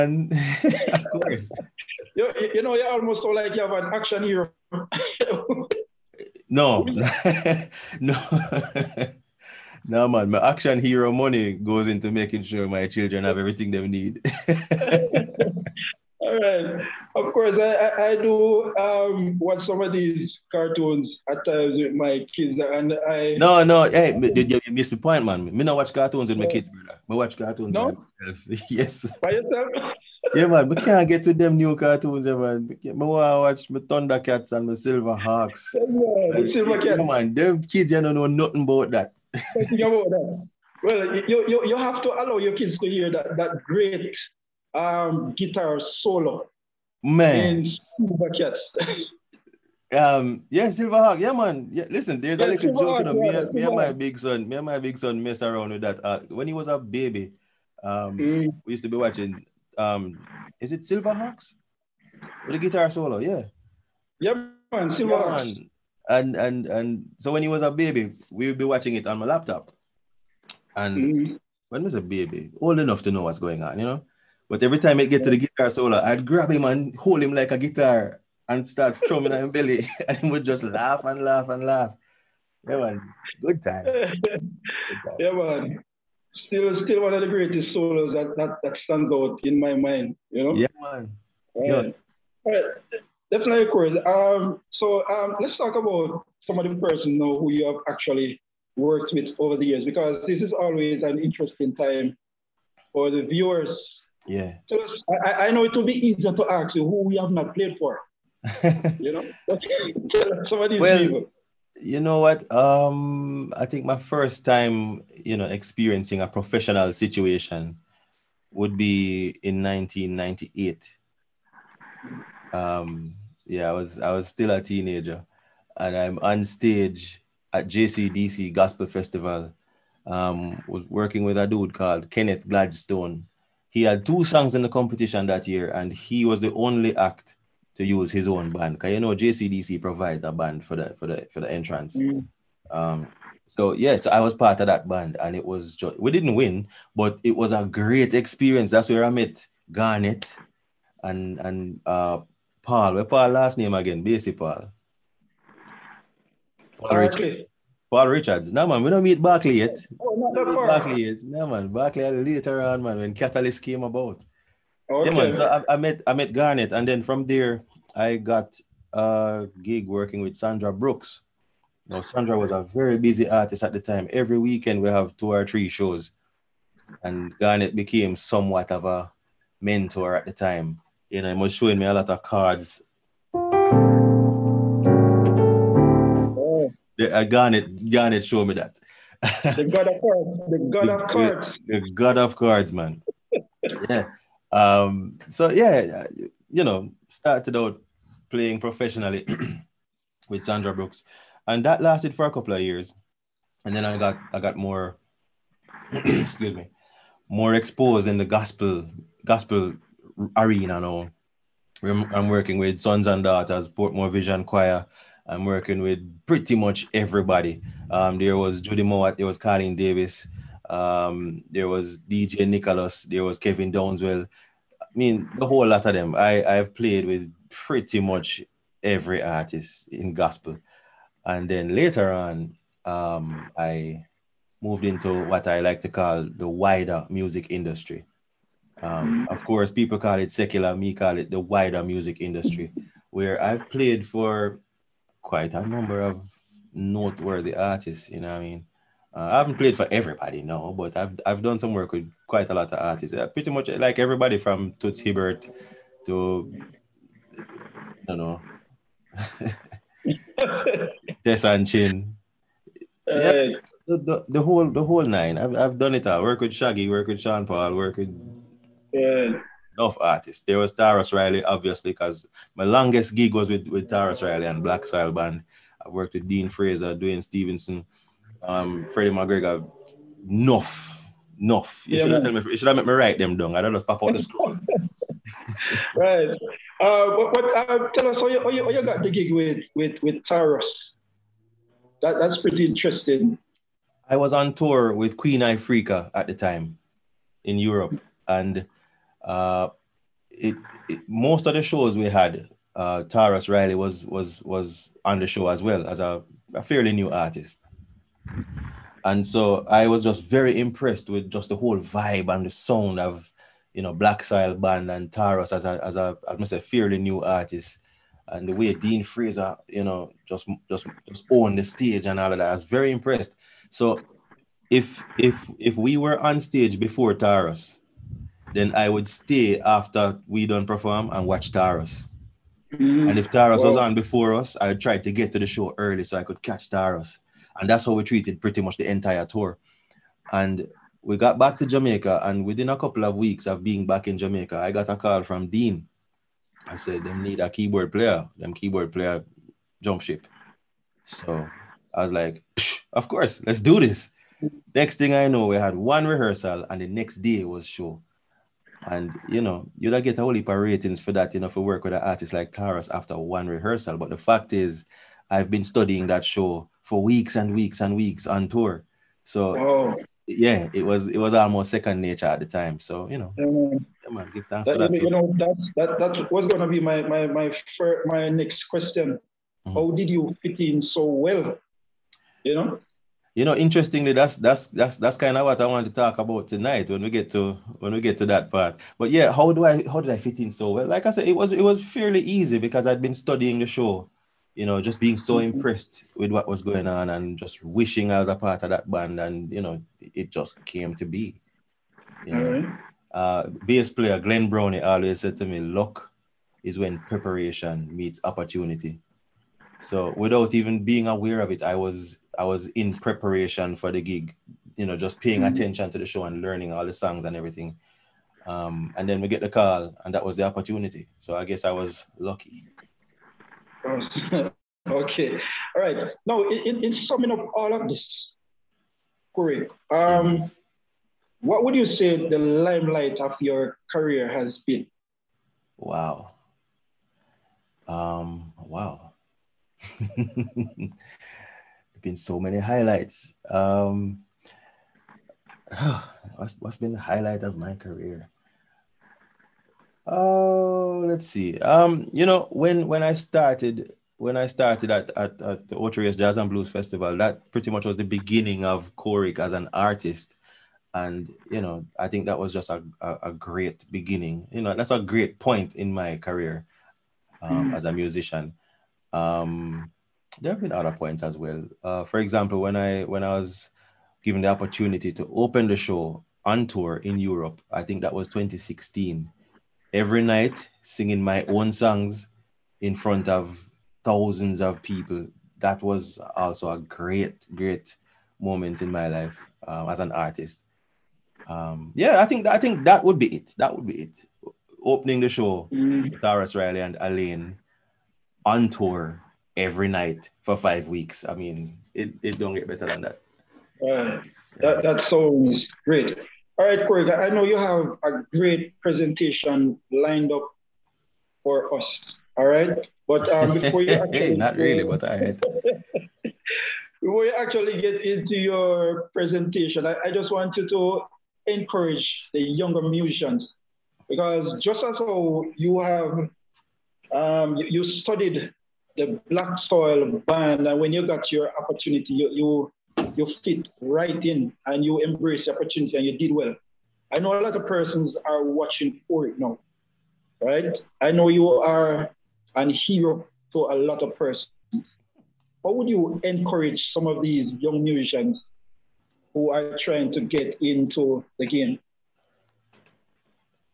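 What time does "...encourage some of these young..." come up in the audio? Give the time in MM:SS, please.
09:06.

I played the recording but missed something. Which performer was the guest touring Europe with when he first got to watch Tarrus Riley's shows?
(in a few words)
Queen Ifrica.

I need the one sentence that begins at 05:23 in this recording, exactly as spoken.
So if if if we were on stage before Tarrus then I would stay after we don't perform and watch Tarrus.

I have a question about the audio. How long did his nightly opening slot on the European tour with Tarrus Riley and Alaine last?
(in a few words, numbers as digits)
5 weeks.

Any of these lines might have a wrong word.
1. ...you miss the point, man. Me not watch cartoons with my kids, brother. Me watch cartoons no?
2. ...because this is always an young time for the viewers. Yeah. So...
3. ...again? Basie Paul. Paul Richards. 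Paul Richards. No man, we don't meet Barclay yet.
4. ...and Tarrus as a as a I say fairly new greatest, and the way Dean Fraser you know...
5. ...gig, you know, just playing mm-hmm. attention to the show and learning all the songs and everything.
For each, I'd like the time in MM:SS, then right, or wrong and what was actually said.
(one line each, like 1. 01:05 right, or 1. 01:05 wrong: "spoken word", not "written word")
1. 00:24 right
2. 01:39 wrong: "interesting", not "young"
3. 02:33 right
4. 05:14 wrong: "artist", not "greatest"
5. 06:54 wrong: "paying", not "playing".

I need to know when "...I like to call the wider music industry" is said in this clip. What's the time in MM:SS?
03:55.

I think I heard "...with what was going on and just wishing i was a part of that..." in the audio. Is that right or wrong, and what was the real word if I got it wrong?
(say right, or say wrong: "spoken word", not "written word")
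right.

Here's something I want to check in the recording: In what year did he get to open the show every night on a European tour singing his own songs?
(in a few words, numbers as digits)
2016.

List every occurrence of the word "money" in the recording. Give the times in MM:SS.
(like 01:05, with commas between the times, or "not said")
00:11.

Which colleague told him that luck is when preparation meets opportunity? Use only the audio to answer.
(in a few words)
Glenn Brownie.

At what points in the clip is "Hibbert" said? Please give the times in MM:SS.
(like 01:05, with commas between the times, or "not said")
04:14.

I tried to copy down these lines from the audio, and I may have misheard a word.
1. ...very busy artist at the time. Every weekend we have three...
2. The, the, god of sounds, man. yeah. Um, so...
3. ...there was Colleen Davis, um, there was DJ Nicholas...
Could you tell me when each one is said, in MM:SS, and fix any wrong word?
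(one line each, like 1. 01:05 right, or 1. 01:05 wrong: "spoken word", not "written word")
1. 02:52 wrong: "two", not "three"
2. 03:11 wrong: "cards", not "sounds"
3. 03:39 right.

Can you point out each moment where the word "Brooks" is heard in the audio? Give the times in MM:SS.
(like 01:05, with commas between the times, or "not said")
02:50, 03:20.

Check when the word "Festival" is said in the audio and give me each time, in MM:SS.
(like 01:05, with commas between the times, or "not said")
02:08, 07:36.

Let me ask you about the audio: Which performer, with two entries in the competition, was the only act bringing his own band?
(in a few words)
Kenneth Gladstone.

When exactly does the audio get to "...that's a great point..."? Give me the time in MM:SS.
07:44.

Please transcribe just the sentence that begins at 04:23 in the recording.
Uh, yeah, the, the, the, whole the whole nine.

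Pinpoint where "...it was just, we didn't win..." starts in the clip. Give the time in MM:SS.
02:25.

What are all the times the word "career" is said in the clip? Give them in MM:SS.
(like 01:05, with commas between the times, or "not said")
07:13, 07:27, 07:46.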